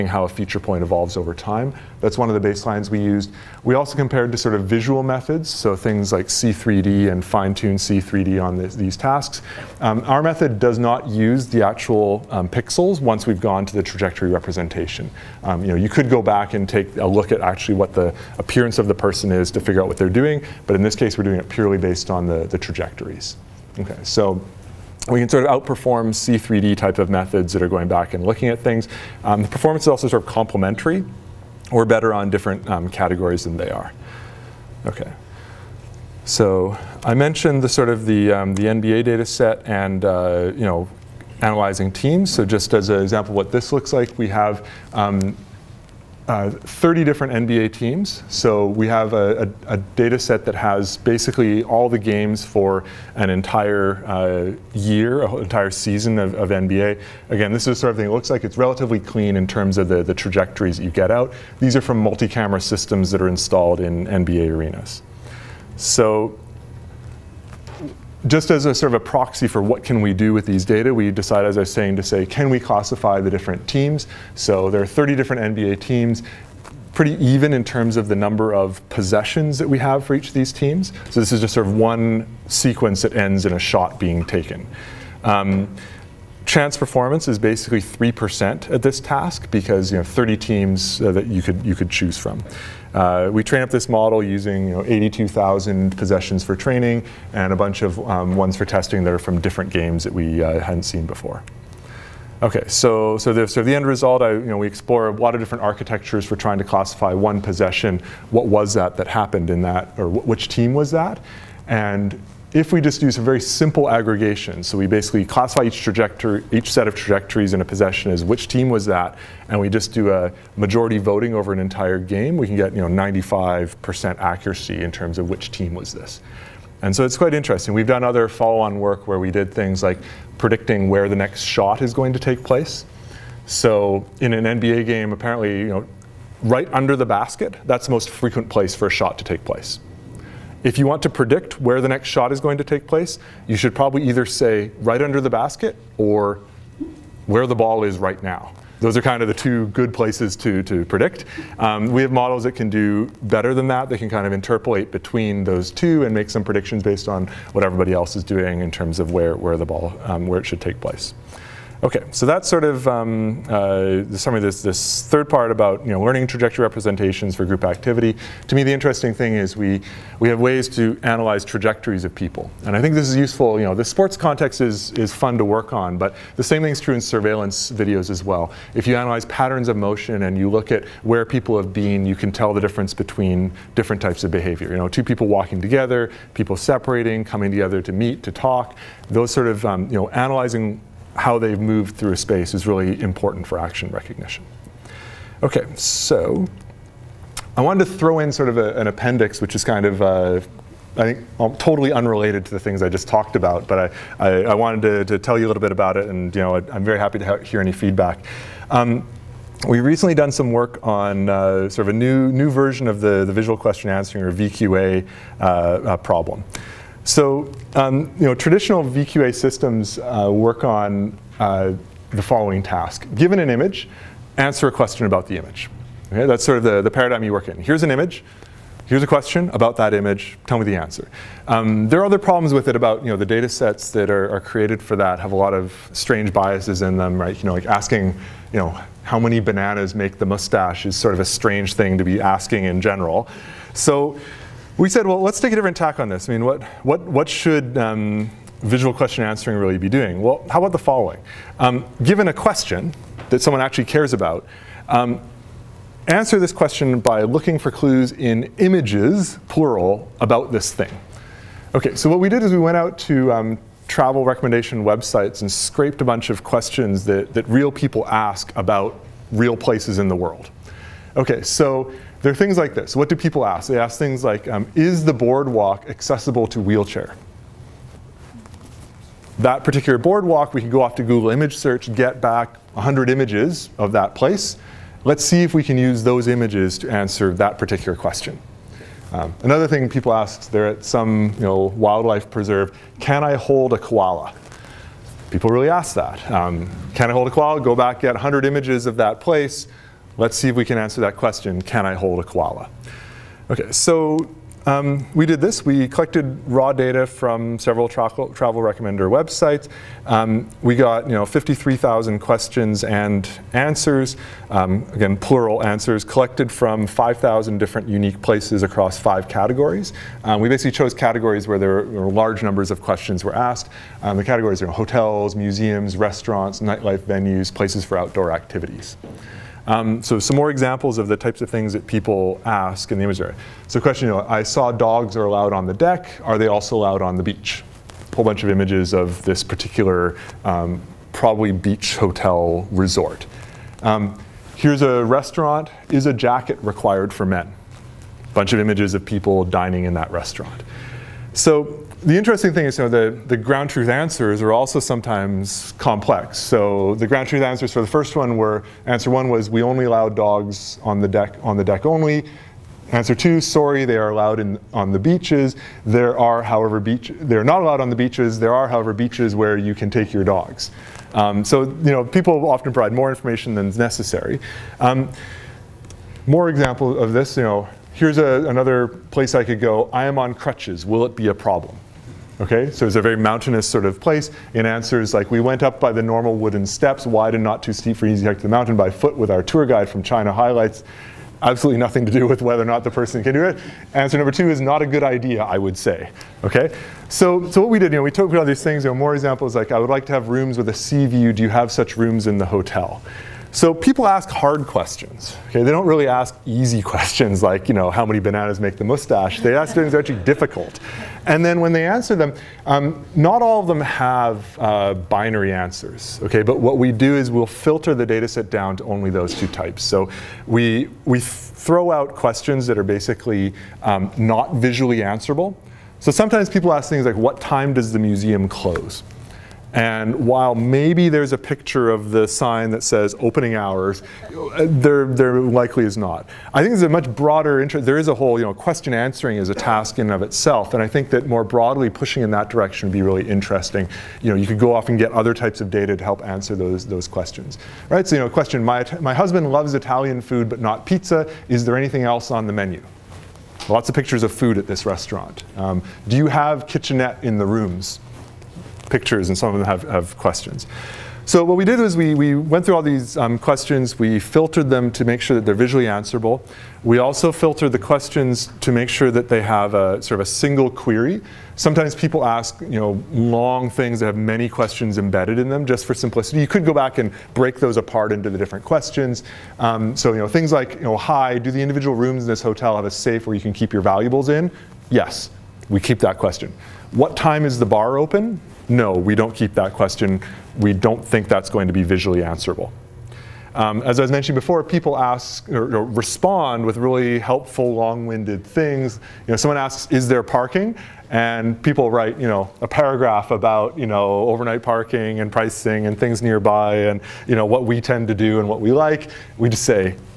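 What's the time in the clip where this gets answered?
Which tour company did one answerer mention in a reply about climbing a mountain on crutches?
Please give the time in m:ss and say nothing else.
6:30.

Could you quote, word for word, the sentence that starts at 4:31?
Okay, so there are things like this.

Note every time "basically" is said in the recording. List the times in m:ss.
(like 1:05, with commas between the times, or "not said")
0:50, 1:27, 1:54, 5:20, 7:02.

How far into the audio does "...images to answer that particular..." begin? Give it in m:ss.
4:46.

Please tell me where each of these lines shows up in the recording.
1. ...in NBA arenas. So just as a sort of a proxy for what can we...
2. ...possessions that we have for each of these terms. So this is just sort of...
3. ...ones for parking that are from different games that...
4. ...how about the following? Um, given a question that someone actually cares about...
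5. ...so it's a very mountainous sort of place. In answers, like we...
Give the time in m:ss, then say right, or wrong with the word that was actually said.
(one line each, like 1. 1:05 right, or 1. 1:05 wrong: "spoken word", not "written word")
1. 1:03 right
2. 1:18 wrong: "teams", not "terms"
3. 1:38 wrong: "testing", not "parking"
4. 4:10 right
5. 6:22 right.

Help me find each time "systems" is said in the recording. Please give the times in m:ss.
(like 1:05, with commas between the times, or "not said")
1:02, 3:39.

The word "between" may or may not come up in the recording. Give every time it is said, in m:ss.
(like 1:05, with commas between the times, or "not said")
2:34, 3:02.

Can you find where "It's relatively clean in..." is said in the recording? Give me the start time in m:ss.
0:58.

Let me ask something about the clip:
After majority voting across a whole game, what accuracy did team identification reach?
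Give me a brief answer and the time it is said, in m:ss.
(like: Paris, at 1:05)
95%, at 2:02.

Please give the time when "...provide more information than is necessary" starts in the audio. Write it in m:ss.
6:12.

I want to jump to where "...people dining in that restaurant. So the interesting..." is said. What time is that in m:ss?
5:49.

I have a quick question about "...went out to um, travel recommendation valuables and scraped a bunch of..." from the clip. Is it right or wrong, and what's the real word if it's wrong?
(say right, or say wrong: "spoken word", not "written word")
wrong: "websites", not "valuables".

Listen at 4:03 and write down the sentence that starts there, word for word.
So we said, well, let's take a different tack on this.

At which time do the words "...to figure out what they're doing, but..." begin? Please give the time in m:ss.
0:19.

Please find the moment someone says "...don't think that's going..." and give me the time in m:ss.
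8:10.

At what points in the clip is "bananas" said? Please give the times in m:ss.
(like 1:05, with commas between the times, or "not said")
3:59, 6:48.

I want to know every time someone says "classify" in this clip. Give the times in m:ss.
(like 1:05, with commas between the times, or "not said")
1:12, 1:46, 1:55.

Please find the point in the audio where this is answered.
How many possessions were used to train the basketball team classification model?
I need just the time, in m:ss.
1:34.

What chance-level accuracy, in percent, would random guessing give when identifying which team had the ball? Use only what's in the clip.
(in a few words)
3%.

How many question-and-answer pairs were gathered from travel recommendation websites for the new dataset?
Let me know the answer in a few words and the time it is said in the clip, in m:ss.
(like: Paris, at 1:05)
53,000, at 5:11.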